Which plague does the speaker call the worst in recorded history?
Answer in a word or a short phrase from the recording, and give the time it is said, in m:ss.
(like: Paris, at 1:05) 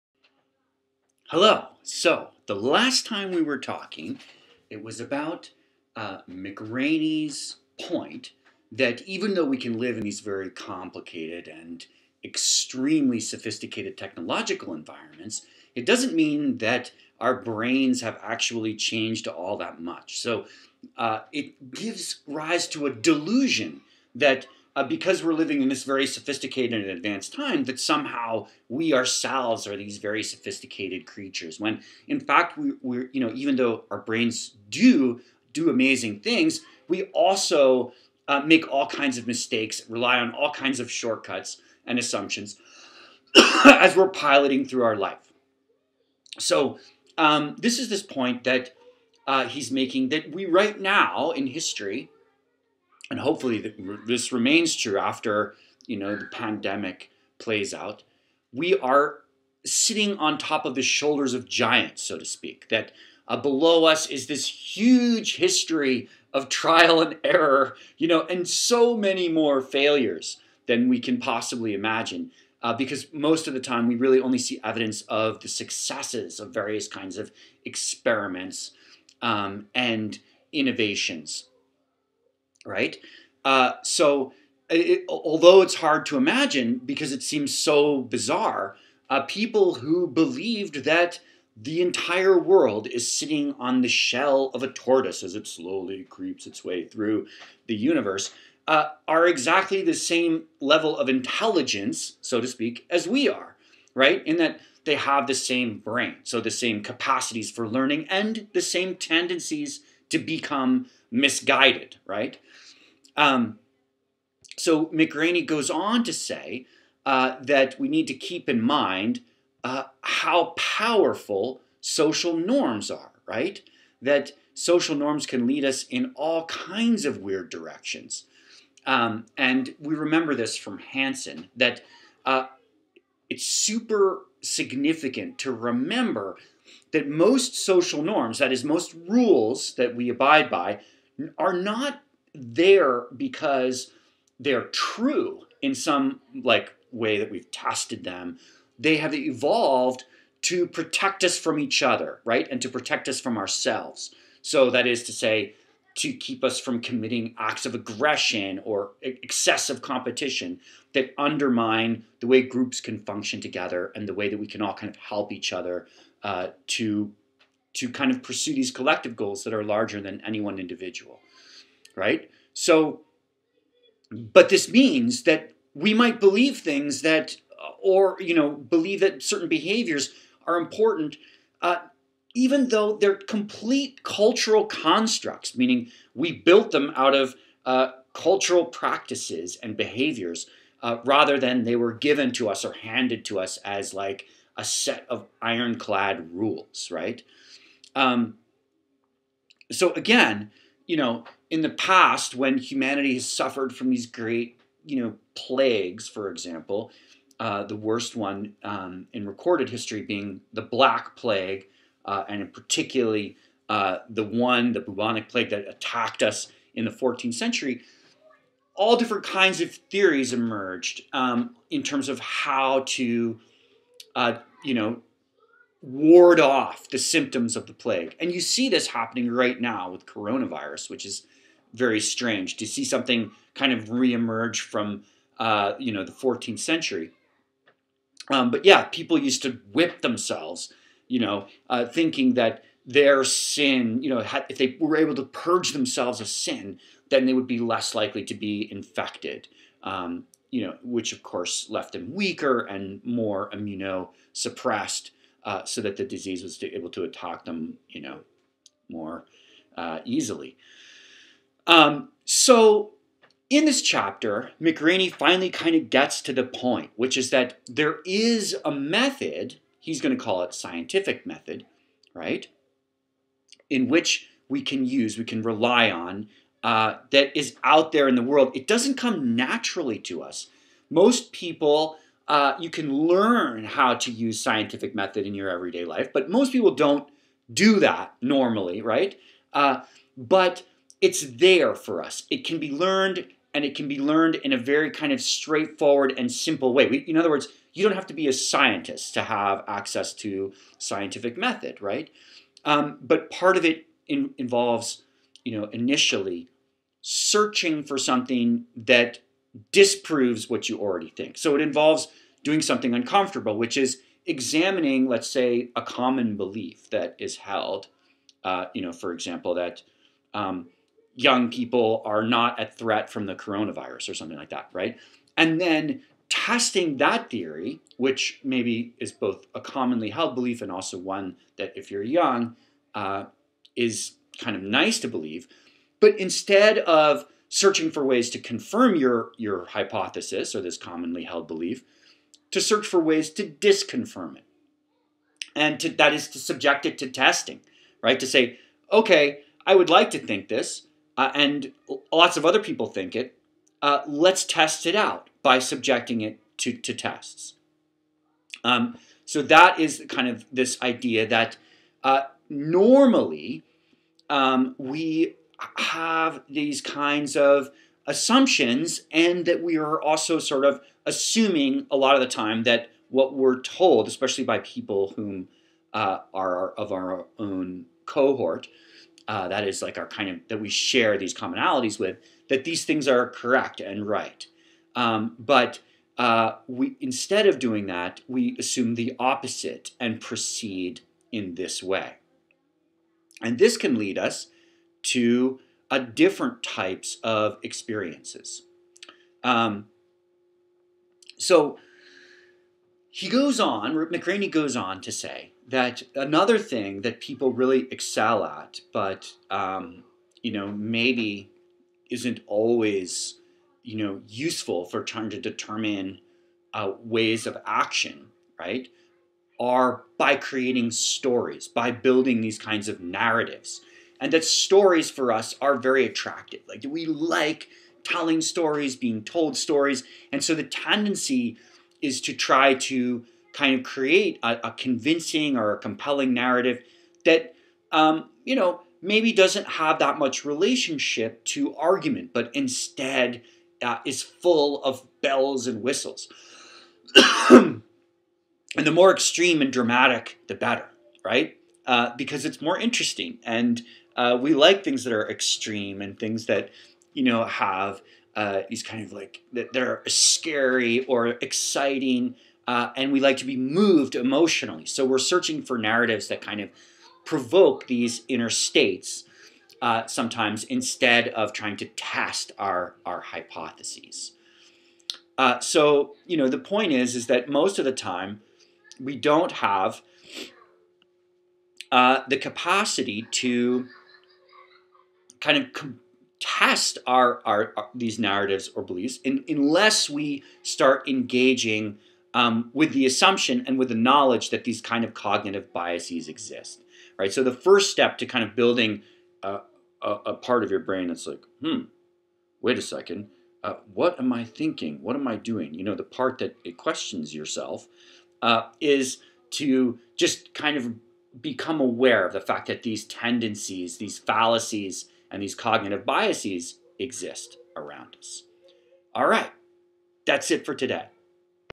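Black Plague, at 3:30.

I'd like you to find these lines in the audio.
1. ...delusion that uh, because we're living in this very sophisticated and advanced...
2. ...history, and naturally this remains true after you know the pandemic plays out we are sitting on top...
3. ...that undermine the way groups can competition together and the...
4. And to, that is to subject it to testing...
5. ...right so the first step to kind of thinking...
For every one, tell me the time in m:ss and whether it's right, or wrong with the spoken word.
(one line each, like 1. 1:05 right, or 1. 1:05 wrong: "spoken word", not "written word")
1. 0:22 right
2. 0:51 wrong: "hopefully", not "naturally"
3. 2:40 wrong: "function", not "competition"
4. 5:45 right
5. 8:17 wrong: "building", not "thinking".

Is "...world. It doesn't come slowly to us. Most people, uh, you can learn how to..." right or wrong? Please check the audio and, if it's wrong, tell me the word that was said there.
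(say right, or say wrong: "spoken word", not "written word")
wrong: "naturally", not "slowly".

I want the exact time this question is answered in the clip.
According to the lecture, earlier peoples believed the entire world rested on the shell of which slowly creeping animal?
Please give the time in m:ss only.
1:34.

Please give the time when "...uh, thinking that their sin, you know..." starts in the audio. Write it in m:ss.
4:01.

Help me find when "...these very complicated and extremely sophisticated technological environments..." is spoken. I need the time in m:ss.
0:10.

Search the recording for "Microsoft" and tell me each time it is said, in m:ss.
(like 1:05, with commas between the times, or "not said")
not said.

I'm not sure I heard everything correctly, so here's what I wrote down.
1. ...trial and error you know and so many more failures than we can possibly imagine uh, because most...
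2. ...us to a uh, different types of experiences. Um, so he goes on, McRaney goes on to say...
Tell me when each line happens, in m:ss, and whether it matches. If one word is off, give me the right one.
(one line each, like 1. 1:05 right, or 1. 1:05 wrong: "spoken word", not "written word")
1. 1:06 right
2. 6:34 right.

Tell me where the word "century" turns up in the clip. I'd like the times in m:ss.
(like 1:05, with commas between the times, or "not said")
3:37, 3:56.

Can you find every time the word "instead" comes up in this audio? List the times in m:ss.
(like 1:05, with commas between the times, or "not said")
5:36, 6:27, 7:22, 7:50.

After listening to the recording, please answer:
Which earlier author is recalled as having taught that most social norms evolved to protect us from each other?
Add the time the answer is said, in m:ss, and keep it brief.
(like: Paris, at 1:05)
Hansen, at 2:10.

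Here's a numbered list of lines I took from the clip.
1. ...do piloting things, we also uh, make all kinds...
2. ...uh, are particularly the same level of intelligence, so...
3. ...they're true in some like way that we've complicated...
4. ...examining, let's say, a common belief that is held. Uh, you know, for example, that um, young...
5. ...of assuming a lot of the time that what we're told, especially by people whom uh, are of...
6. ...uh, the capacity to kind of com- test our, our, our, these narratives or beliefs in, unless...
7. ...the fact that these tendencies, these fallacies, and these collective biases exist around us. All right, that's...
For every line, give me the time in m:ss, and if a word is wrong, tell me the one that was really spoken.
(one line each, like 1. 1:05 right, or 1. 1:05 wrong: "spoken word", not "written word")
1. 0:35 wrong: "amazing", not "piloting"
2. 1:38 wrong: "exactly", not "particularly"
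3. 2:24 wrong: "tested", not "complicated"
4. 5:14 right
5. 6:10 right
6. 8:01 right
7. 8:32 wrong: "cognitive", not "collective".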